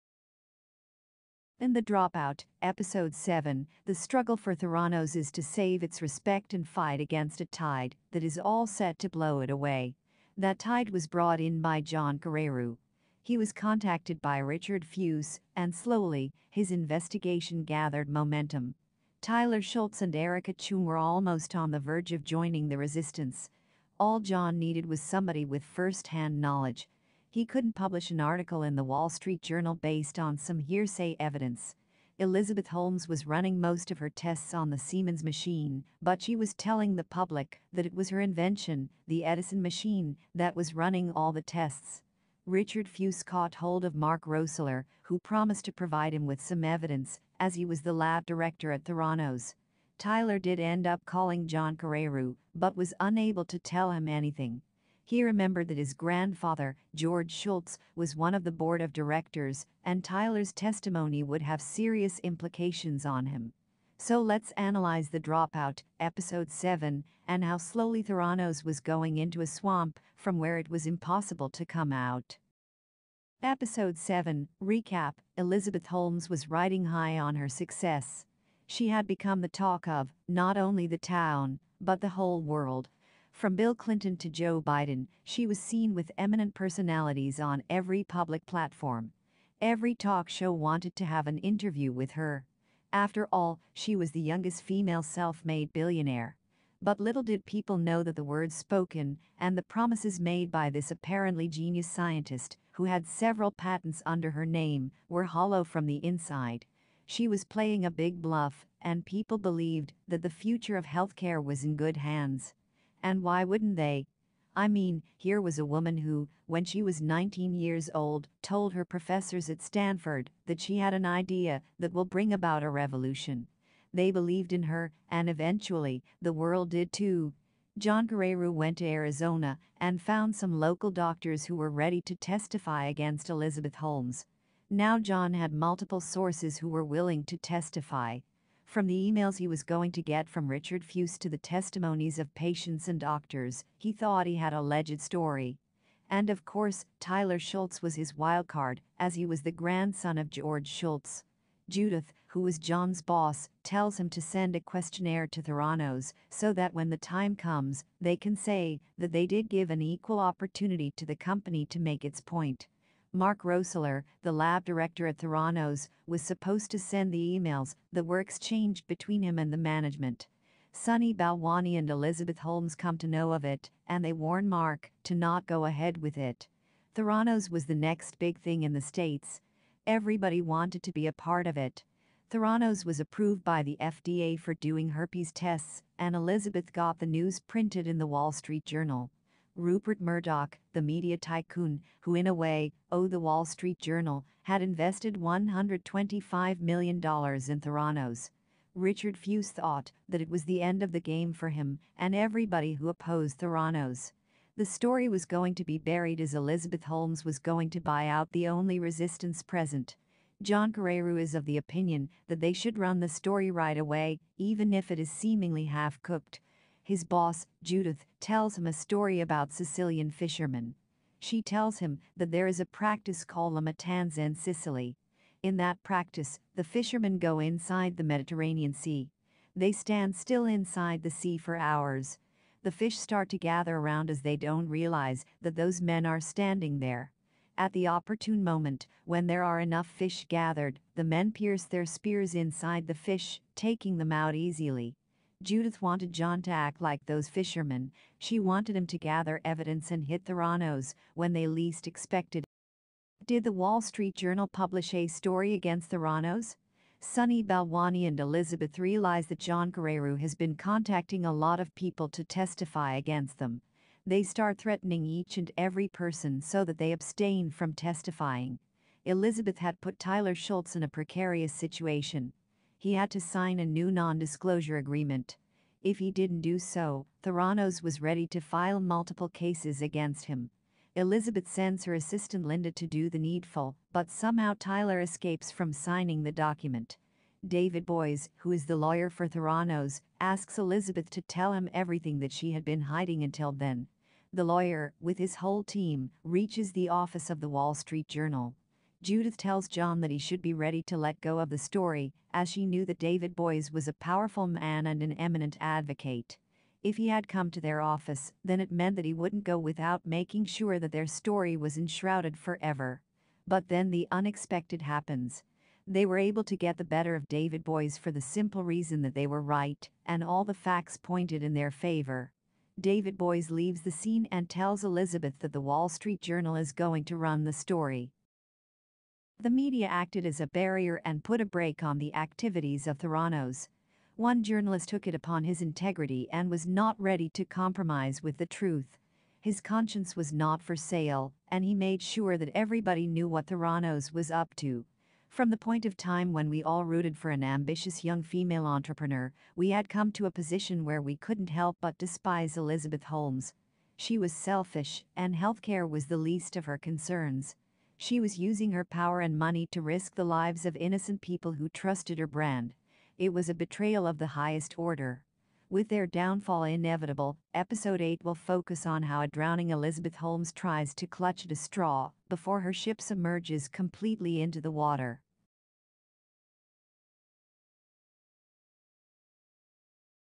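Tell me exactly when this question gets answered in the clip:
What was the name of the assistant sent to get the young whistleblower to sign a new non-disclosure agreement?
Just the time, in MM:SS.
04:42.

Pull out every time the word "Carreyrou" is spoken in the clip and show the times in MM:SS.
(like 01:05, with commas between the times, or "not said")
00:12, 00:51, 02:08, 03:30, 04:19.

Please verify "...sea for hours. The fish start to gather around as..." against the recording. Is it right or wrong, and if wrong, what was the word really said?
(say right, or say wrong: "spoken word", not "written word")
right.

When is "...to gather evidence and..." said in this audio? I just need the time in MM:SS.
04:08.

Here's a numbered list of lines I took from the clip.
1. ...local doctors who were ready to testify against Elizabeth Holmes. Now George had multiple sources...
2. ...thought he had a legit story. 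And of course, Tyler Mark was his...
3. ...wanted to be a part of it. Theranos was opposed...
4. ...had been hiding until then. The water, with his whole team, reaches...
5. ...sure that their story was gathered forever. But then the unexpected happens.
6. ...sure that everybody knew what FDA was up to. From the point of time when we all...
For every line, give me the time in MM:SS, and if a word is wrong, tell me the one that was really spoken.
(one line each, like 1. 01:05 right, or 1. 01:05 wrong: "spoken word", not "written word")
1. 02:10 wrong: "John", not "George"
2. 02:23 wrong: "Shultz", not "Mark"
3. 03:00 wrong: "approved", not "opposed"
4. 04:52 wrong: "lawyer", not "water"
5. 05:10 wrong: "enshrouded", not "gathered"
6. 05:42 wrong: "Theranos", not "FDA".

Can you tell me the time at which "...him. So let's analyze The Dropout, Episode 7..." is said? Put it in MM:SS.
01:03.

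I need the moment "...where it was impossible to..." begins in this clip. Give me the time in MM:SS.
01:10.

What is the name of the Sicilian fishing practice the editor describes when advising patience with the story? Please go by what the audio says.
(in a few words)
La Matanza.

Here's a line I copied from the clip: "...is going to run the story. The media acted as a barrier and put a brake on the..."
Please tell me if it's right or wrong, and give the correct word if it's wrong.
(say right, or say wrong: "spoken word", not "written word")
right.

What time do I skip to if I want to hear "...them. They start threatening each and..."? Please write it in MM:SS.
04:23.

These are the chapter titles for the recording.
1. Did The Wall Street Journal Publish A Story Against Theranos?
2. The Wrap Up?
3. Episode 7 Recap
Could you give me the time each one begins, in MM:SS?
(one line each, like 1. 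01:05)
1. 04:13
2. 05:29
3. 01:13.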